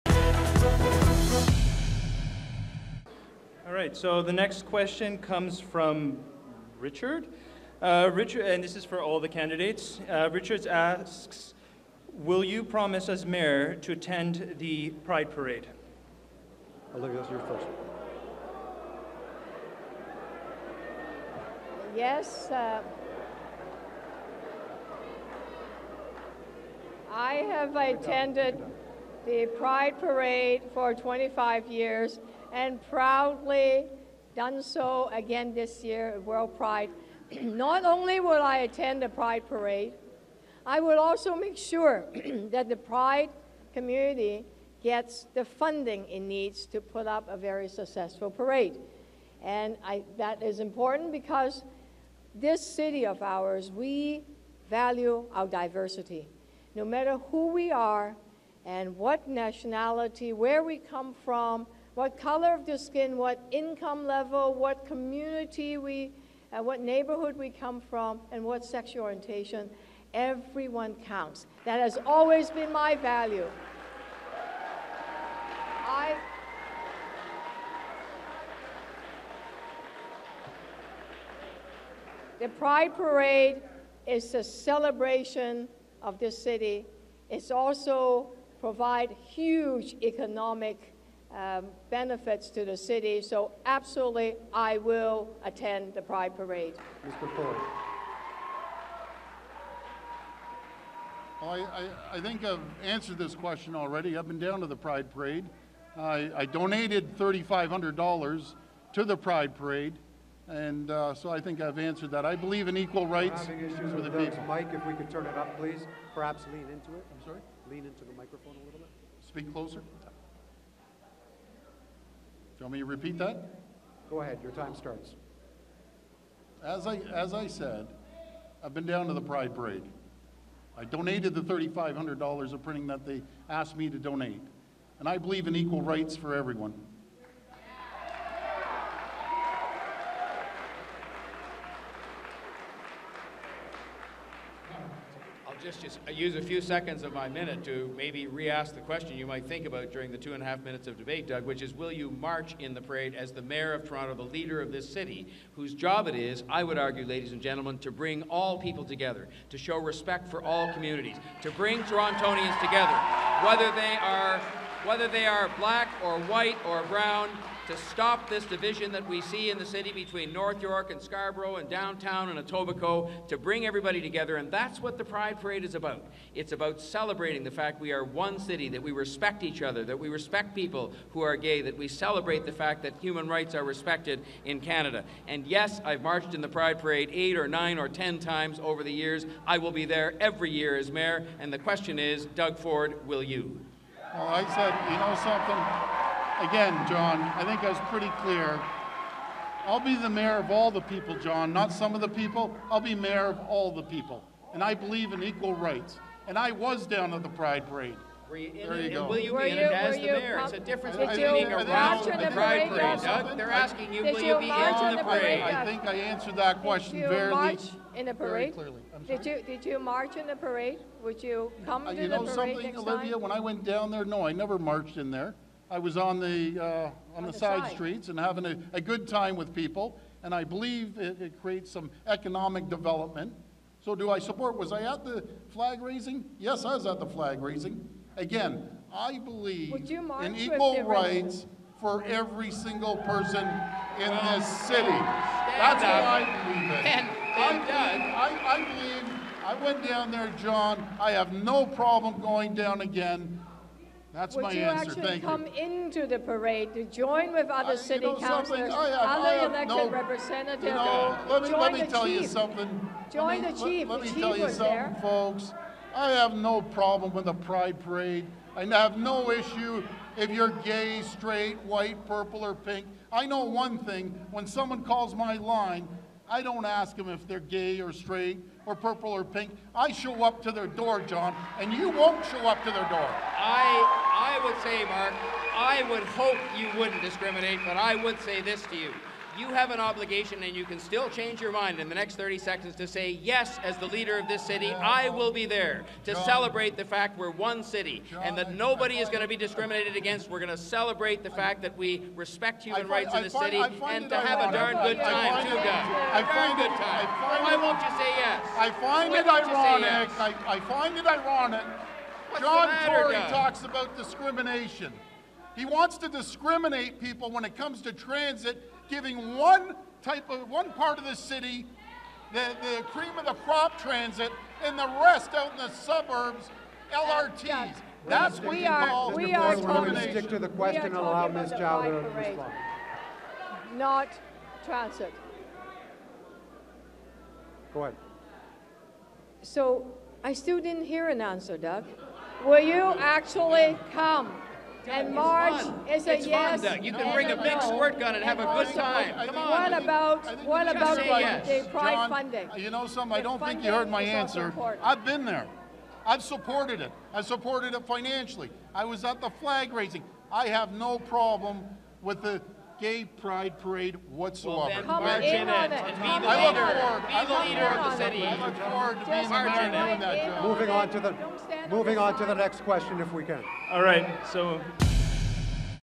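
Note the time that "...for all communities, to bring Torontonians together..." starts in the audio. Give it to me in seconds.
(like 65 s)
160 s.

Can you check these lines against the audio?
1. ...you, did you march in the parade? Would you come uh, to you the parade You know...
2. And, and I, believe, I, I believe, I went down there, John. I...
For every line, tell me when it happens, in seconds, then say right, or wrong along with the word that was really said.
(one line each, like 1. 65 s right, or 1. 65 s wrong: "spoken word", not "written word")
1. 219 s right
2. 246 s right.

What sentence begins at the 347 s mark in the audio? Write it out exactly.
squirt gun and have a good time.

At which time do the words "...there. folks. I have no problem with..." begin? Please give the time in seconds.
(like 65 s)
264 s.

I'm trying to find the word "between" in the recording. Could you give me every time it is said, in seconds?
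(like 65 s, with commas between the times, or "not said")
169 s, 211 s.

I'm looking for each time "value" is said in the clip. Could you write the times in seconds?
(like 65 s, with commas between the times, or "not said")
54 s, 72 s.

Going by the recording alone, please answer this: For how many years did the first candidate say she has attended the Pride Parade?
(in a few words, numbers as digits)
25.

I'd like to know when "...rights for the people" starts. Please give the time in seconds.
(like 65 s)
113 s.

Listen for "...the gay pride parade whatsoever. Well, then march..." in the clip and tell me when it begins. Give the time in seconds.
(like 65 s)
362 s.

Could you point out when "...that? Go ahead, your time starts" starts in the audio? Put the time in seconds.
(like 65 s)
123 s.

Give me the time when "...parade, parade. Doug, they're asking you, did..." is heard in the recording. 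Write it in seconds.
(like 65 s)
212 s.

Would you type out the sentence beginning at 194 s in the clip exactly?
Well, I said, you know something?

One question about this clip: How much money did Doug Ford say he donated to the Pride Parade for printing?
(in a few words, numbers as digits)
$3,500.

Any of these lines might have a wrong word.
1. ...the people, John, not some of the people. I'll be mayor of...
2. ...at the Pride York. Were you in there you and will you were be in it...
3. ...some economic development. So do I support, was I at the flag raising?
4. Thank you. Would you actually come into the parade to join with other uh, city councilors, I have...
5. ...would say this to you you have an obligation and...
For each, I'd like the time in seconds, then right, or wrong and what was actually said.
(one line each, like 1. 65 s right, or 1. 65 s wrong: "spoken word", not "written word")
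1. 200 s right
2. 207 s wrong: "Parade", not "York"
3. 231 s right
4. 254 s right
5. 288 s right.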